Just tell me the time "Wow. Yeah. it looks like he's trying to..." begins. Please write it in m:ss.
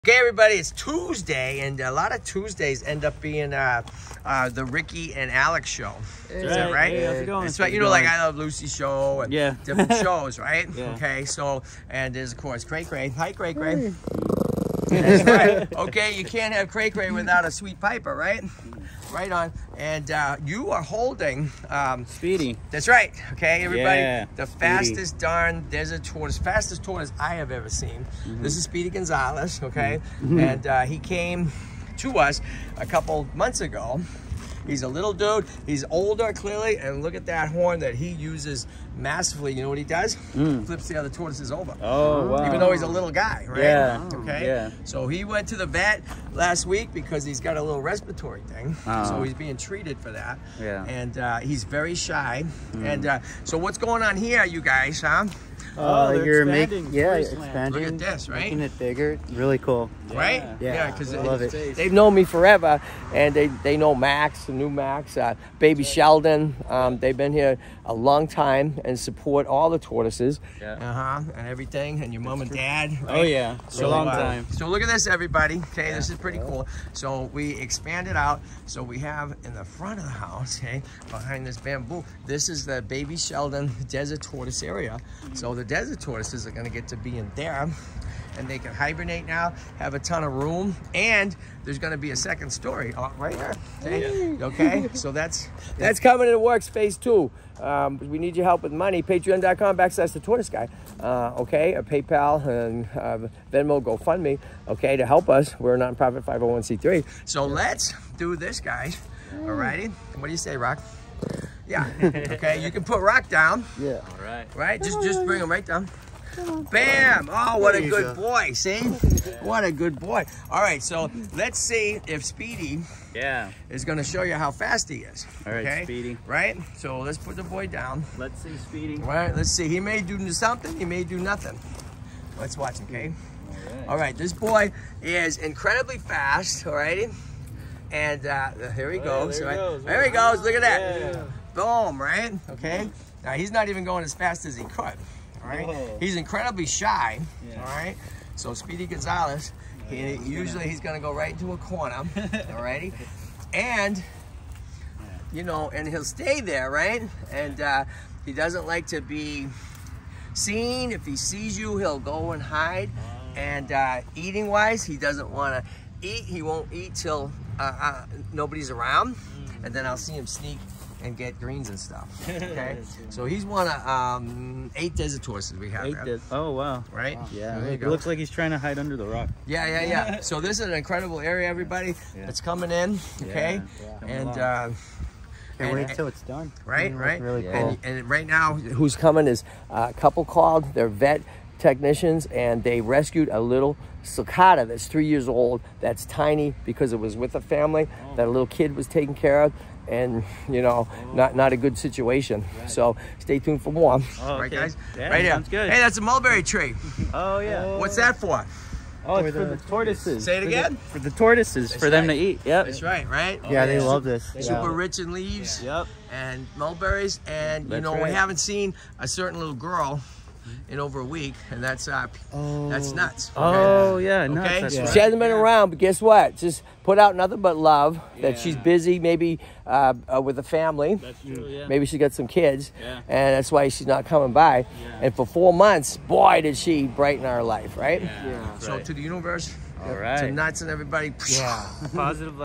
2:57.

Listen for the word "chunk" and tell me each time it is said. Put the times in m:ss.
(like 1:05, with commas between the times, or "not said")
not said.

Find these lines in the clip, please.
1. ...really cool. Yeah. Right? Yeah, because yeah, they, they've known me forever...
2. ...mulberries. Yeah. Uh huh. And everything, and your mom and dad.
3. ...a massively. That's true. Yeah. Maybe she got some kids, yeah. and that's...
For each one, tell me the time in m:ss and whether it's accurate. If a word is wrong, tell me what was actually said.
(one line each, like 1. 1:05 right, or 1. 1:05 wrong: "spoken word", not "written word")
1. 0:59 right
2. 1:09 wrong: "tortoises", not "mulberries"
3. 3:50 wrong: "family", not "massively".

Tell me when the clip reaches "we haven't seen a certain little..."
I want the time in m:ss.
3:38.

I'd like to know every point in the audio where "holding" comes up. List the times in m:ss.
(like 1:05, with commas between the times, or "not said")
0:20.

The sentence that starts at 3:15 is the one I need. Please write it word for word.
That's tiny because it was with a family oh.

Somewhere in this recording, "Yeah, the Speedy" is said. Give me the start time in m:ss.
0:24.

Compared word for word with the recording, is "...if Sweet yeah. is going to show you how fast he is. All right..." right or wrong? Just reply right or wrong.
wrong.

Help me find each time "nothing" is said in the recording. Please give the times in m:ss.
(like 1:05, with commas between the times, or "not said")
2:11, 3:47.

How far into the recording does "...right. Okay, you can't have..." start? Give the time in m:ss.
0:15.